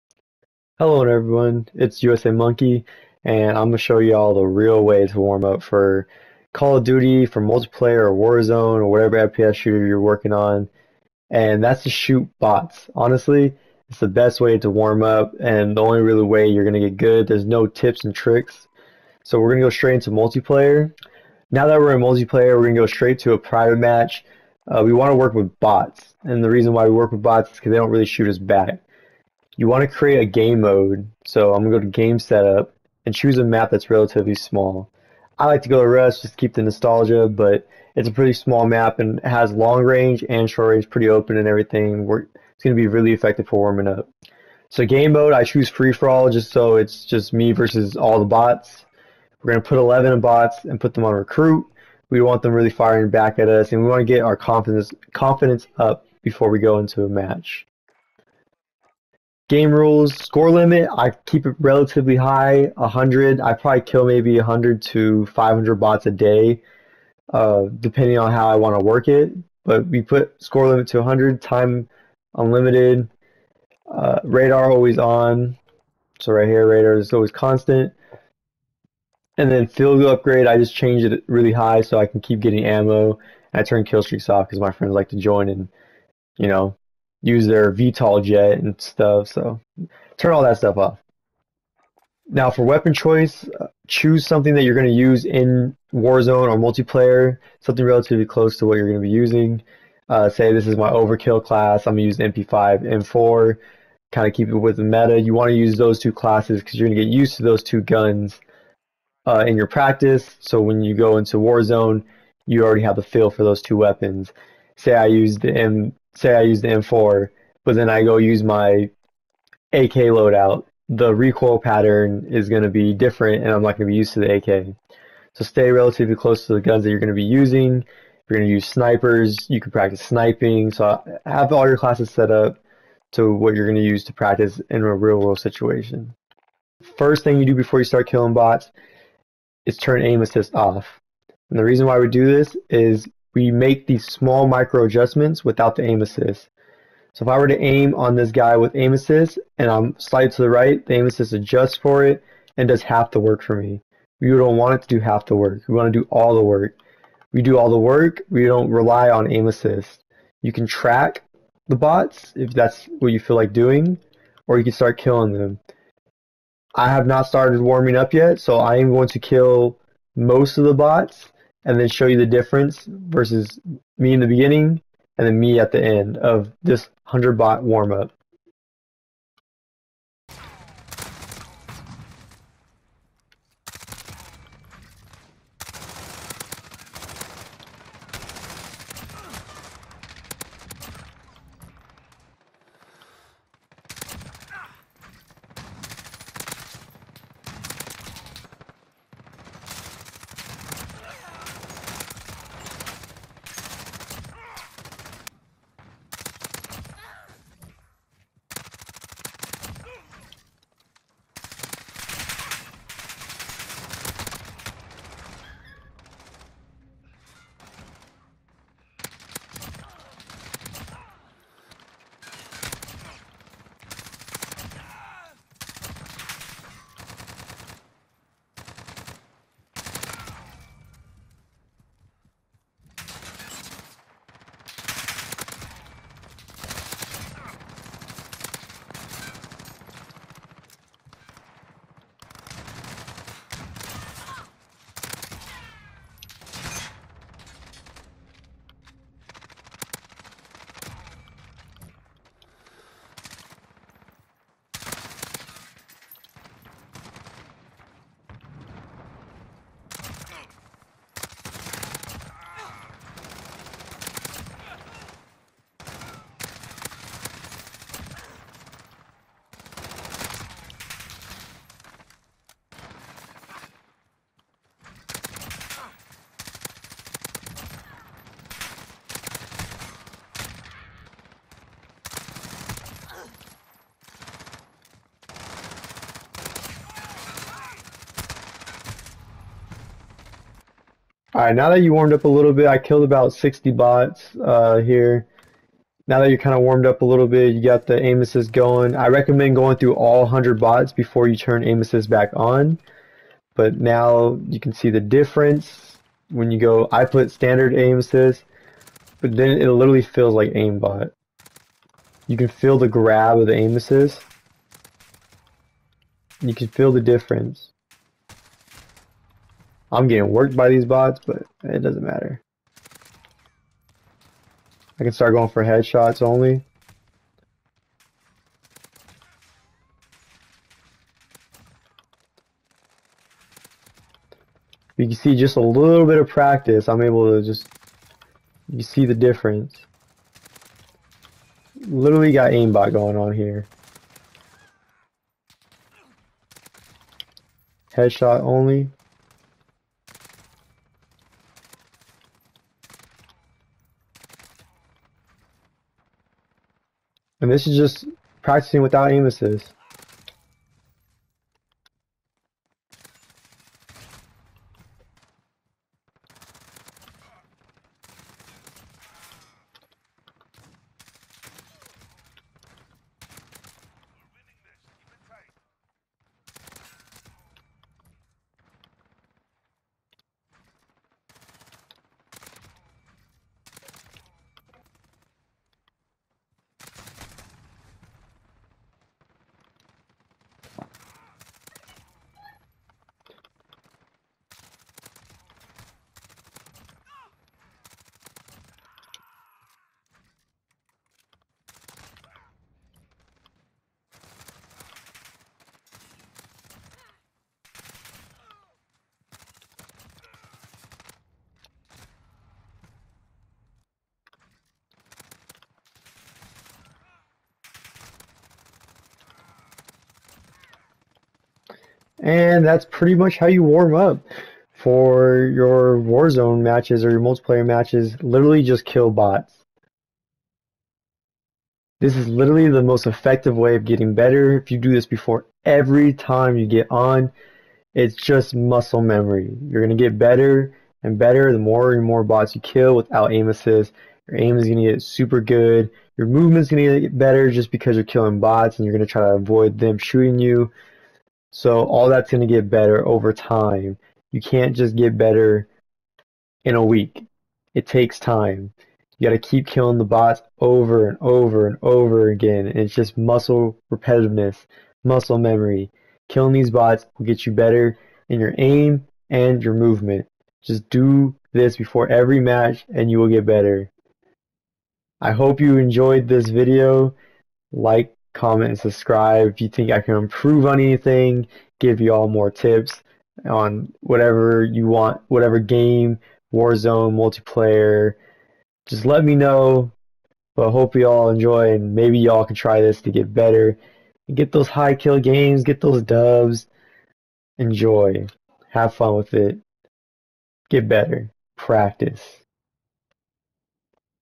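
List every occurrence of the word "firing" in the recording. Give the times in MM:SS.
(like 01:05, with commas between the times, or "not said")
00:52.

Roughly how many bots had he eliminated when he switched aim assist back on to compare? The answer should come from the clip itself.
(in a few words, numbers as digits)
60.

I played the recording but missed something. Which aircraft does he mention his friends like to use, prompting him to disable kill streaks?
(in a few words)
VTOL jet.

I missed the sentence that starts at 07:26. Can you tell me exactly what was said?
Your movement's going to get better just because you're killing bots and you're going to try to avoid them shooting you.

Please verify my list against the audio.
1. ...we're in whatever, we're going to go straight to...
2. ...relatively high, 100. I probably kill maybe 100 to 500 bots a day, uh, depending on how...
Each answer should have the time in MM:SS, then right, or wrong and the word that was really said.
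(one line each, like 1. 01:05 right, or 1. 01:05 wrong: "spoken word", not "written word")
1. 00:21 wrong: "multiplayer", not "whatever"
2. 01:01 right.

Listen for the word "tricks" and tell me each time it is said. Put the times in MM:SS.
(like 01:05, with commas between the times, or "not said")
00:18.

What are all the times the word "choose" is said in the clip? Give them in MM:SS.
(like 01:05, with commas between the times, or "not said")
00:33, 00:45, 01:33.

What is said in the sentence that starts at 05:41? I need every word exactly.
Literally got aimbot going on here.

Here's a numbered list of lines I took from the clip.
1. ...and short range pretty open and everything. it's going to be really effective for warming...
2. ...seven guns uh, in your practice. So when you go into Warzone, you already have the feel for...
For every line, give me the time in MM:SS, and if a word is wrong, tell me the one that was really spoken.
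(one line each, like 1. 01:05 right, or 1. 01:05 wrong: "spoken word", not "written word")
1. 00:40 right
2. 01:47 wrong: "two", not "seven".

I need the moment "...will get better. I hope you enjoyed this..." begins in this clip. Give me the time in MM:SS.
07:53.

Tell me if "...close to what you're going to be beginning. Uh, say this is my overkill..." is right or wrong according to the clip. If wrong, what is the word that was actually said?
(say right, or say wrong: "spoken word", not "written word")
wrong: "using", not "beginning".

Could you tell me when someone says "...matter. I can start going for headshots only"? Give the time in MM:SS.
05:22.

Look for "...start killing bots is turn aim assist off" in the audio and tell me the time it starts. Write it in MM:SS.
02:17.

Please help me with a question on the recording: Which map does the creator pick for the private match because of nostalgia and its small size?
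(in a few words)
Rust.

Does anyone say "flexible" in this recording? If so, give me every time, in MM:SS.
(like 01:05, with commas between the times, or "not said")
not said.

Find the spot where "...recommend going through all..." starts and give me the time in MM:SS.
04:59.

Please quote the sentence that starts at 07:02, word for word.
And that's pretty much how you warm up for your Warzone matches or your multiplayer matches.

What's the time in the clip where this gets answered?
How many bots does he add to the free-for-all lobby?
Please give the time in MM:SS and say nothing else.
00:49.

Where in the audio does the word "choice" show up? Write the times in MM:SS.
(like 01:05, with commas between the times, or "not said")
01:32.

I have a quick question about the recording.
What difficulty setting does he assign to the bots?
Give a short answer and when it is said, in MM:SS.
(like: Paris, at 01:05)
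Recruit, at 00:51.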